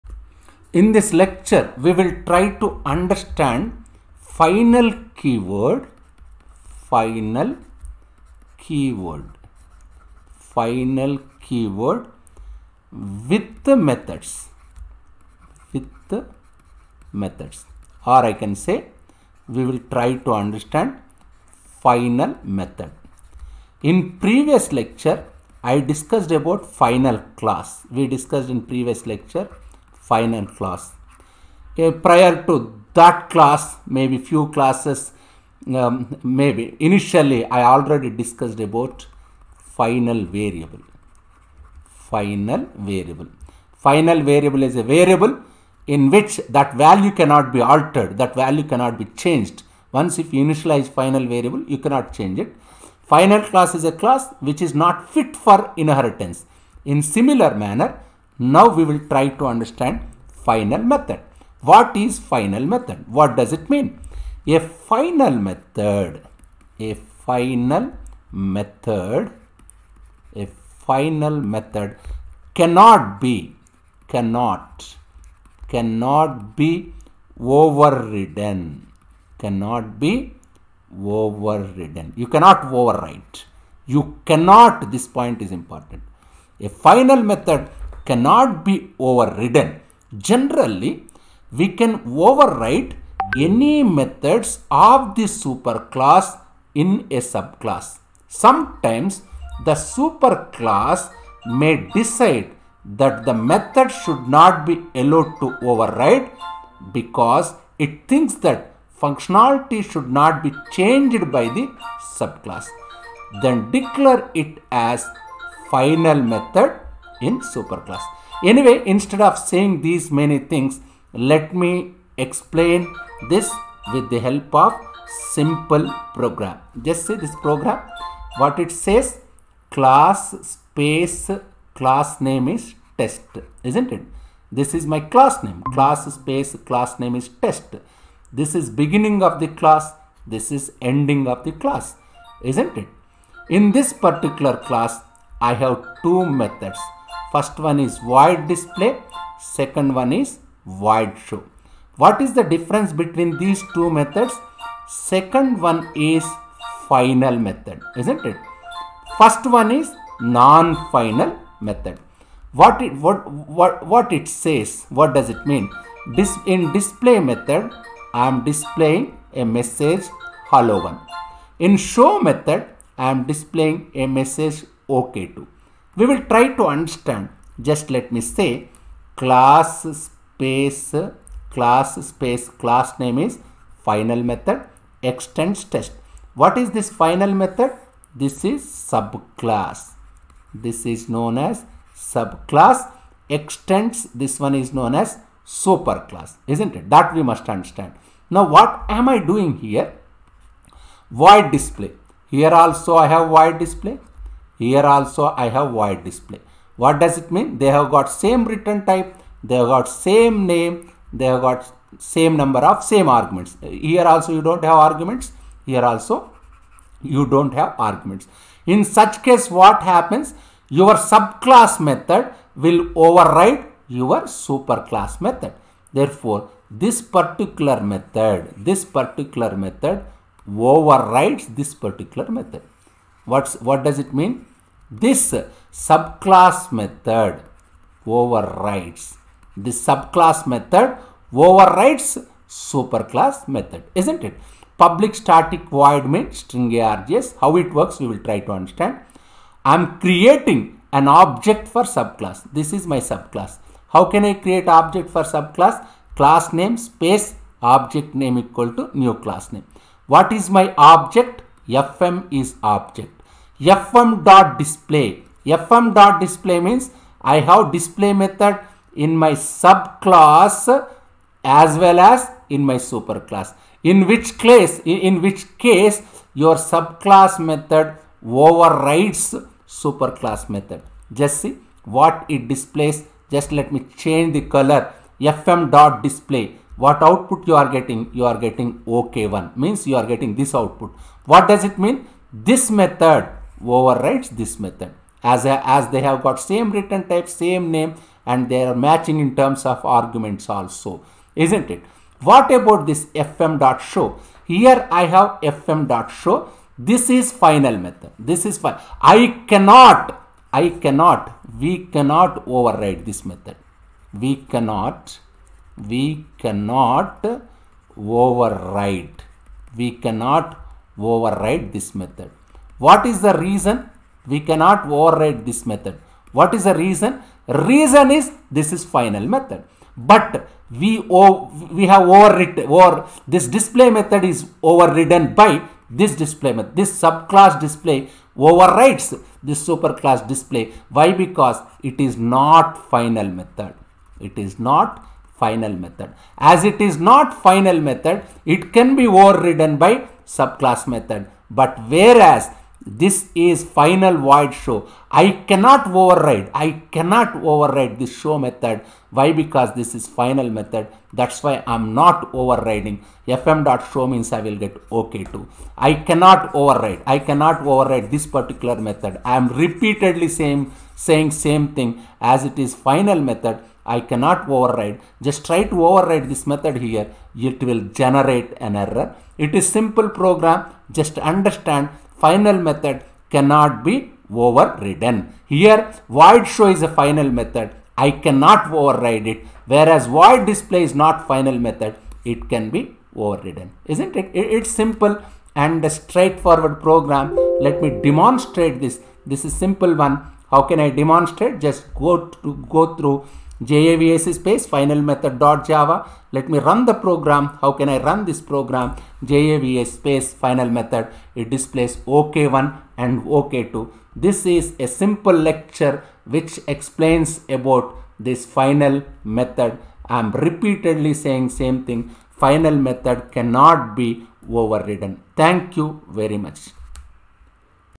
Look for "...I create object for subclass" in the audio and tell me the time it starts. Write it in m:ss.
4:14.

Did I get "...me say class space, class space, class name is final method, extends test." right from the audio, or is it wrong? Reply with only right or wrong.
right.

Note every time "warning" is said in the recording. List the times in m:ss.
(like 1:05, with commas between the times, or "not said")
not said.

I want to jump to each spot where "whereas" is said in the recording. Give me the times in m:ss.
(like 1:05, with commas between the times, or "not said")
5:51, 6:29.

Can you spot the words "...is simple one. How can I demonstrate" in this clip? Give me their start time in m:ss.
6:39.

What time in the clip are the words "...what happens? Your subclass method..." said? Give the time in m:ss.
3:39.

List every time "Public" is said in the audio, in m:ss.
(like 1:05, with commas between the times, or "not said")
4:04.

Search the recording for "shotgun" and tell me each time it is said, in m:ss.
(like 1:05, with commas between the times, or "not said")
not said.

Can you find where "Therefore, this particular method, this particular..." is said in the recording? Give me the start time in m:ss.
3:45.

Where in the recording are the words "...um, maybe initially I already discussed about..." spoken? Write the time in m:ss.
0:35.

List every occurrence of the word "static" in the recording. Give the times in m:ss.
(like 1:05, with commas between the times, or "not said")
4:05.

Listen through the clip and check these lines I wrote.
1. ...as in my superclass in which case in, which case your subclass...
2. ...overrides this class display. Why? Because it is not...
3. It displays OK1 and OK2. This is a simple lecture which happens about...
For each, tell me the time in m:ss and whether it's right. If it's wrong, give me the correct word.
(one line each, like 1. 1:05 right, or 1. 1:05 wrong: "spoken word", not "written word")
1. 4:31 right
2. 5:38 wrong: "superclass", not "class"
3. 6:51 wrong: "explains", not "happens".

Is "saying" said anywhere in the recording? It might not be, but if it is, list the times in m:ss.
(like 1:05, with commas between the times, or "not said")
1:59, 6:10, 7:01.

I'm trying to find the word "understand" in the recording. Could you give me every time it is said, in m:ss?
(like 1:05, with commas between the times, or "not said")
0:02, 0:20, 0:59, 2:56, 3:17, 4:08, 6:21.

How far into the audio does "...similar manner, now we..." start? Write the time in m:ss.
0:57.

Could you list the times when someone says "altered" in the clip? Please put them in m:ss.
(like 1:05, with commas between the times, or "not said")
0:47.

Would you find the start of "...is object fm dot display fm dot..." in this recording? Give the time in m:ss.
4:22.